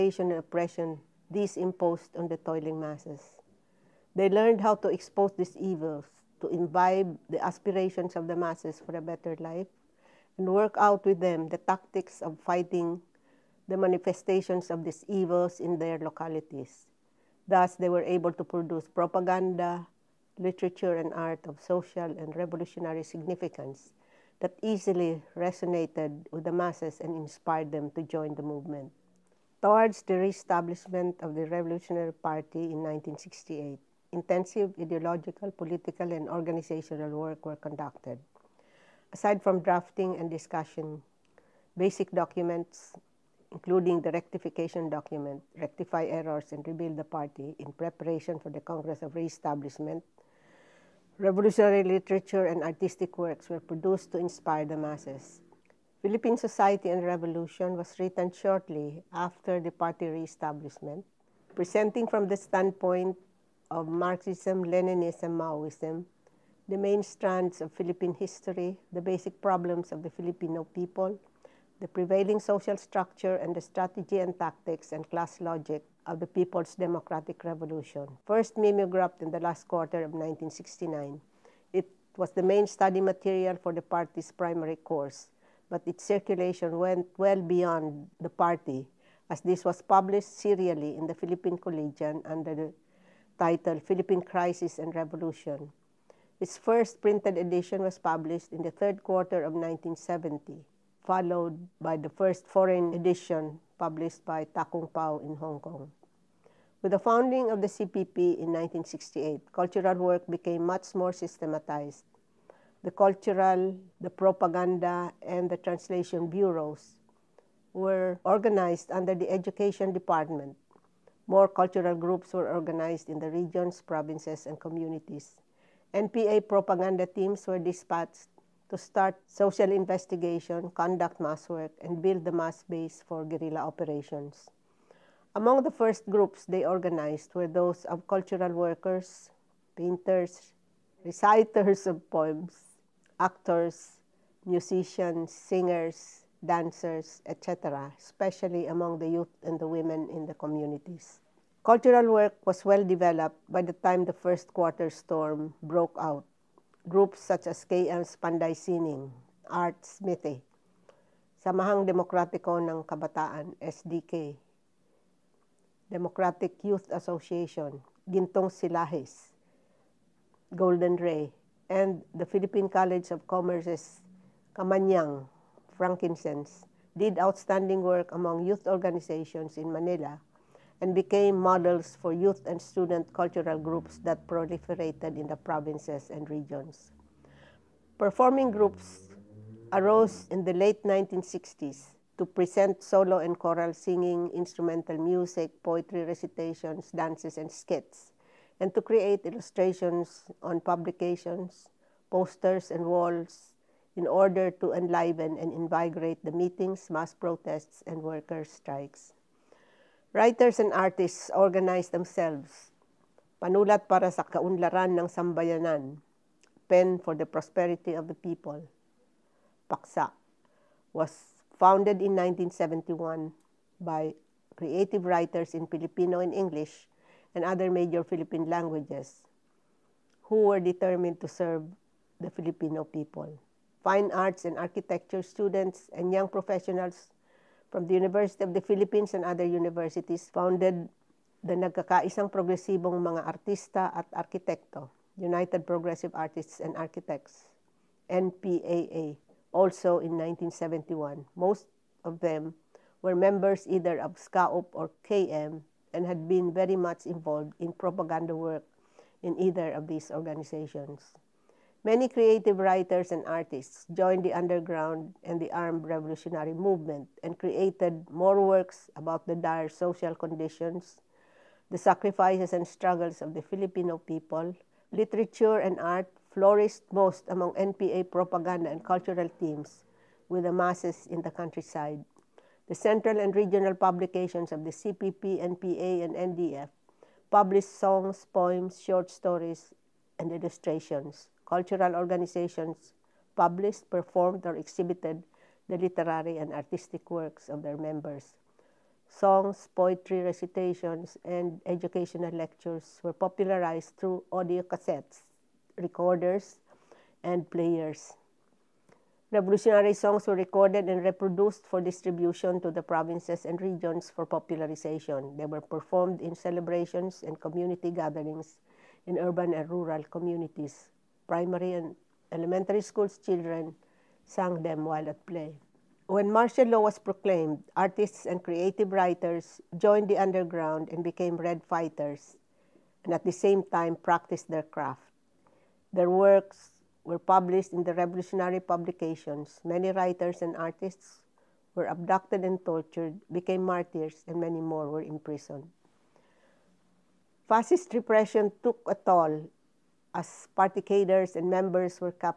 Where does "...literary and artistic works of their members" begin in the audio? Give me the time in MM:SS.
04:55.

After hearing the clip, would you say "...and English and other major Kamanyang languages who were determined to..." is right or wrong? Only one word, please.
wrong.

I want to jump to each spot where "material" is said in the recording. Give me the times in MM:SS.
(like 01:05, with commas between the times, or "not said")
01:23.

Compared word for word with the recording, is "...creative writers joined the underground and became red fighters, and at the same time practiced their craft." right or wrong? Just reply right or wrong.
right.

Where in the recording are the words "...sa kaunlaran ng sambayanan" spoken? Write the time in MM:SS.
03:34.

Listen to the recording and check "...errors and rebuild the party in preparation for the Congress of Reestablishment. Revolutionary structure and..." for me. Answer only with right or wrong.
wrong.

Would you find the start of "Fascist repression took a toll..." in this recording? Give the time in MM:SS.
05:47.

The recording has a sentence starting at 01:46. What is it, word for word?
With the founding of the CPP in 1968, cultural work became much more systematized.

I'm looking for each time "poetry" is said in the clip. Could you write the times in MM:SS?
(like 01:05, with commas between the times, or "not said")
03:15, 04:59.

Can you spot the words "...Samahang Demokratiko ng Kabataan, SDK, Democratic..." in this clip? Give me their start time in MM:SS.
02:41.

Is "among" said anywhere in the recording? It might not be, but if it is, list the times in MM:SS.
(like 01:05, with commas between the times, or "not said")
02:15, 02:28, 02:58, 04:37.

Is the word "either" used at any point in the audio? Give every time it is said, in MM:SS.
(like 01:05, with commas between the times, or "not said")
04:13, 04:19.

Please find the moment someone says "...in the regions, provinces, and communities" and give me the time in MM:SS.
02:03.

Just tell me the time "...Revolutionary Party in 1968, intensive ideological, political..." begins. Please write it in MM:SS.
00:31.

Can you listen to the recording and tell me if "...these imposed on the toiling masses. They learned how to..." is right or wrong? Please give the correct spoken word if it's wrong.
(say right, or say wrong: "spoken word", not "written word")
right.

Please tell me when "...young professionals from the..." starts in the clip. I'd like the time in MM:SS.
03:56.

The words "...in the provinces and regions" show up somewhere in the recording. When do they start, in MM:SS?
03:05.